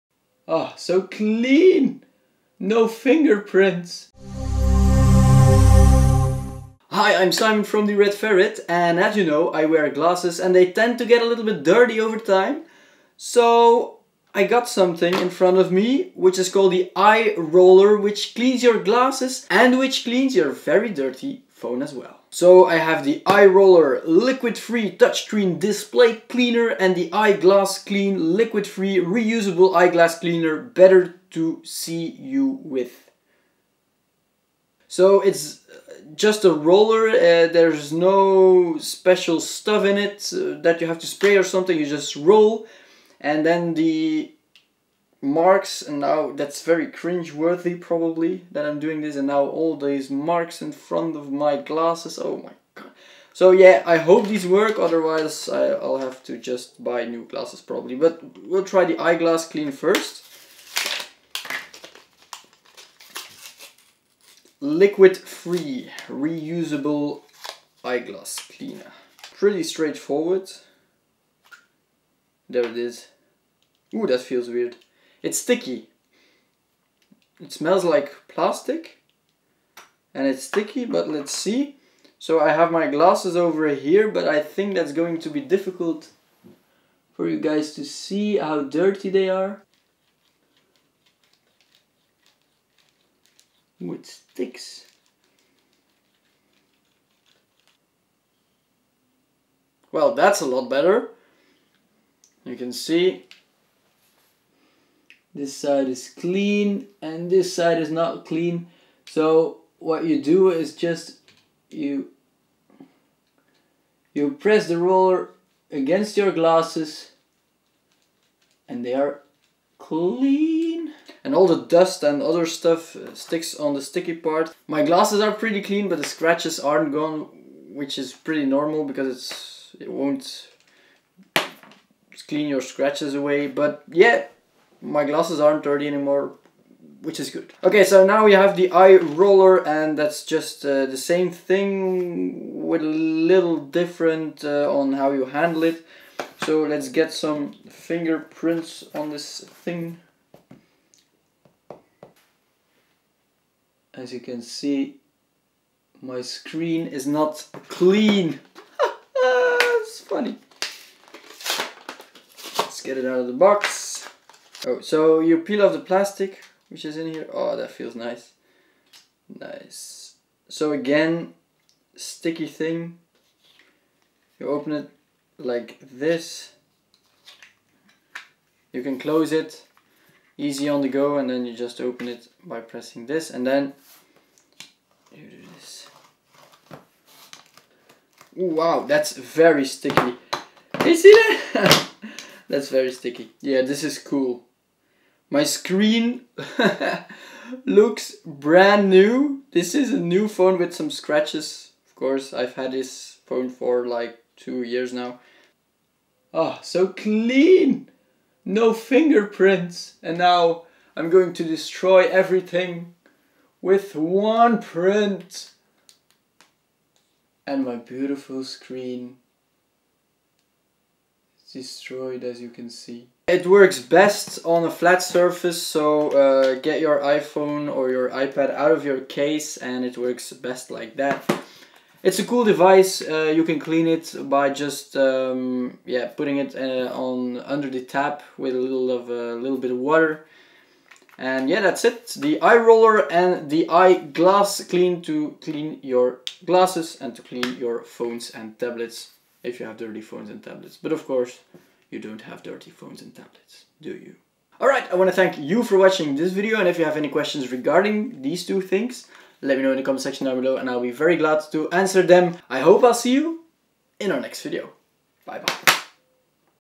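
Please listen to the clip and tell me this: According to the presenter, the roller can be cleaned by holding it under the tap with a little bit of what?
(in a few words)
Water.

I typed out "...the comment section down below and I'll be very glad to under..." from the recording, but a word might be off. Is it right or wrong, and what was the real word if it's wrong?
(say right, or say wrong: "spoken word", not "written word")
wrong: "answer", not "under".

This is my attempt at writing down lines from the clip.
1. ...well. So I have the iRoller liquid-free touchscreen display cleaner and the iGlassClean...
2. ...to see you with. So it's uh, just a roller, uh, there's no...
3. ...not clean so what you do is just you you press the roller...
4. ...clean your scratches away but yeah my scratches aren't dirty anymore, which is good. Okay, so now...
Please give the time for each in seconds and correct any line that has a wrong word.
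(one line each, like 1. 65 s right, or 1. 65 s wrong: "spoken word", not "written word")
1. 21 s right
2. 31 s right
3. 107 s right
4. 132 s wrong: "glasses", not "scratches".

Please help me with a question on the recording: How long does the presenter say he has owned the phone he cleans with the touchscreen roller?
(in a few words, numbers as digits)
2 years.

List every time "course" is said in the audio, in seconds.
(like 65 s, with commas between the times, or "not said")
201 s, 251 s.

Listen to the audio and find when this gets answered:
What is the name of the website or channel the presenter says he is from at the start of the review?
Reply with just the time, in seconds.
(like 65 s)
7 s.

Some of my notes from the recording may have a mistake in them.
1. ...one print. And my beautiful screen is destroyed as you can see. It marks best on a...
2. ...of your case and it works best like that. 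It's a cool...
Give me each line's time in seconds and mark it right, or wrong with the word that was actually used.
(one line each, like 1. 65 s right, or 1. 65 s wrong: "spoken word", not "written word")
1. 213 s wrong: "works", not "marks"
2. 228 s right.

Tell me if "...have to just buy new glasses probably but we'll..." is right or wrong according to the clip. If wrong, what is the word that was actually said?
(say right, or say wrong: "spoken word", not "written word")
right.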